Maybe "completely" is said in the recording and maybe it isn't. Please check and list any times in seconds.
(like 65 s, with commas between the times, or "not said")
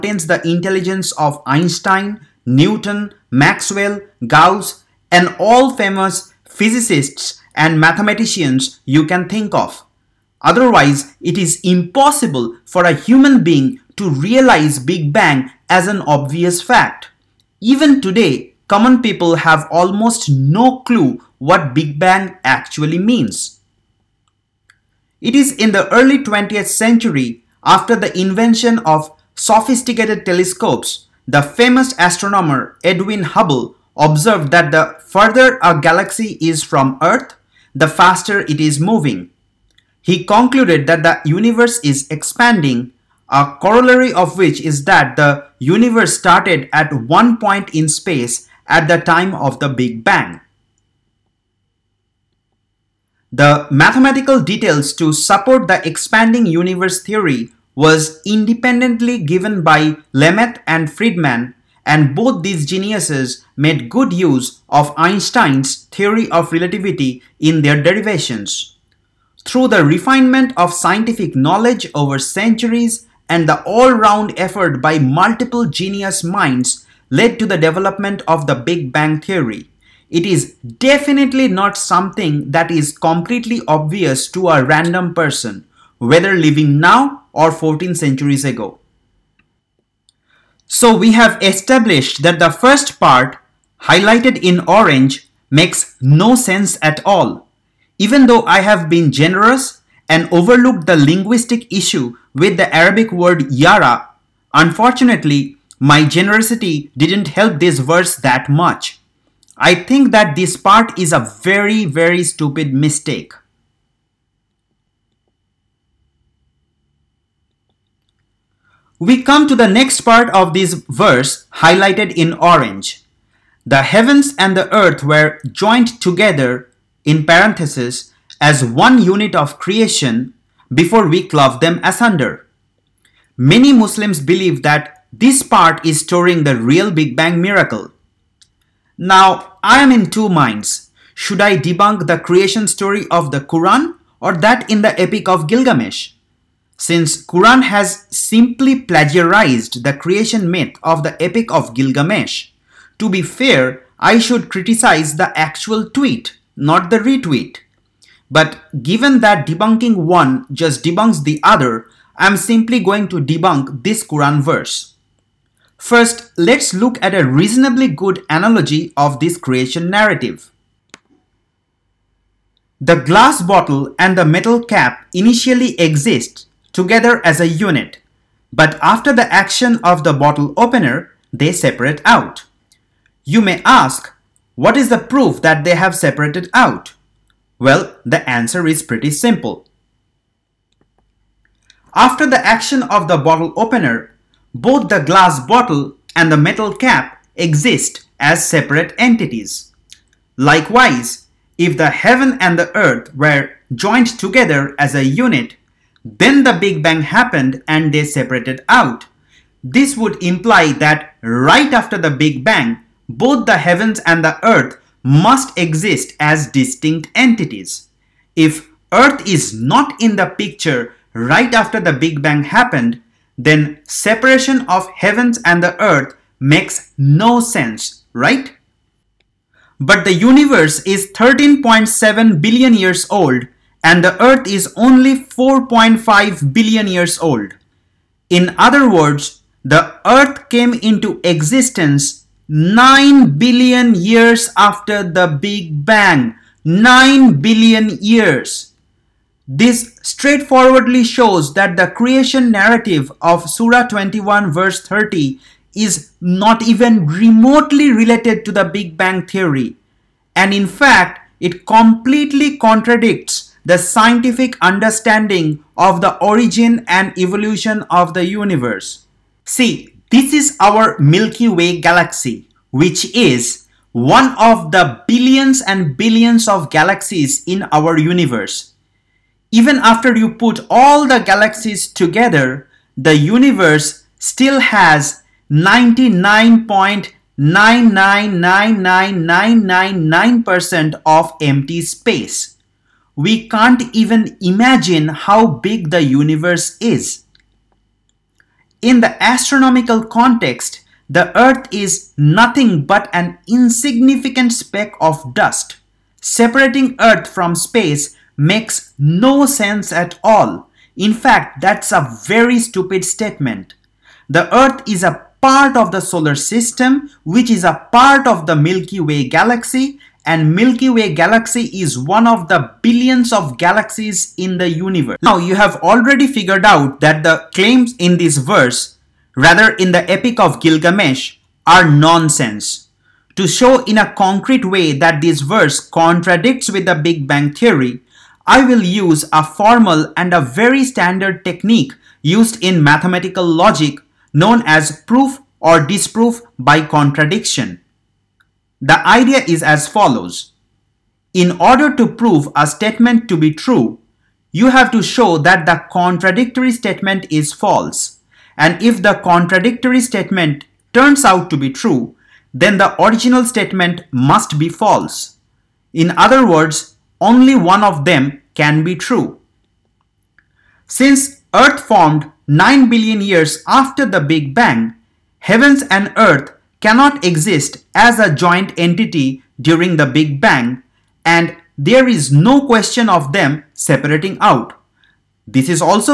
82 s, 261 s.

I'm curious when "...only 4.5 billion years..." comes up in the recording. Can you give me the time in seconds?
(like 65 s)
234 s.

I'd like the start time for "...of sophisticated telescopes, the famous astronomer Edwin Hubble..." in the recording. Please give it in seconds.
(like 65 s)
28 s.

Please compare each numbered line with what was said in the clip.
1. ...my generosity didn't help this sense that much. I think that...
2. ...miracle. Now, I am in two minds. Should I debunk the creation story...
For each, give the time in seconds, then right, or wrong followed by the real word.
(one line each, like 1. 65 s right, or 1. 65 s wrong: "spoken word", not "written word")
1. 105 s wrong: "verse", not "sense"
2. 137 s right.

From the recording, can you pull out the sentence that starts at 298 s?
In the astronomical context, the Earth is nothing but an insignificant speck of dust.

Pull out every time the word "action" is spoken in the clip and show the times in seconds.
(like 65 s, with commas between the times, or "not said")
179 s, 192 s.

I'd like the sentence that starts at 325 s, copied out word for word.
Now you have already figured out that the claims in this verse, rather in the Epic of Gilgamesh, are nonsense.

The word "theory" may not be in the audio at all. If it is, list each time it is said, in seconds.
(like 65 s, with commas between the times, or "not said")
57 s, 65 s, 79 s, 259 s, 337 s.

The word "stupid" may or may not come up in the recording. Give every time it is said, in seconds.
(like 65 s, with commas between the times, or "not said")
112 s, 312 s.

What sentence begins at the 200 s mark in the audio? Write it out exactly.
Likewise, if the heaven and the earth were joined together as a unit, then the Big Bang happened and they separated out.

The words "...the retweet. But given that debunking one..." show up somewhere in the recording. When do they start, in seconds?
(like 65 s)
156 s.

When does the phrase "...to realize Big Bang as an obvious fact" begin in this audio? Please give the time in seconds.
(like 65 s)
13 s.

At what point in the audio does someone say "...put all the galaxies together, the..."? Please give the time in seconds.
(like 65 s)
280 s.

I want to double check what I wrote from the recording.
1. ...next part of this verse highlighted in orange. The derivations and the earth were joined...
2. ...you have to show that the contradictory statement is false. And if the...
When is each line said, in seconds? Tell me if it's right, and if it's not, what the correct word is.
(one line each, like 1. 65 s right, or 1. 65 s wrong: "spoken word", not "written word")
1. 119 s wrong: "heavens", not "derivations"
2. 354 s right.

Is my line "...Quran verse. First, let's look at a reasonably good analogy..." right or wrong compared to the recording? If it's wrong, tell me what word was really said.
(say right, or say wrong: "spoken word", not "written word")
right.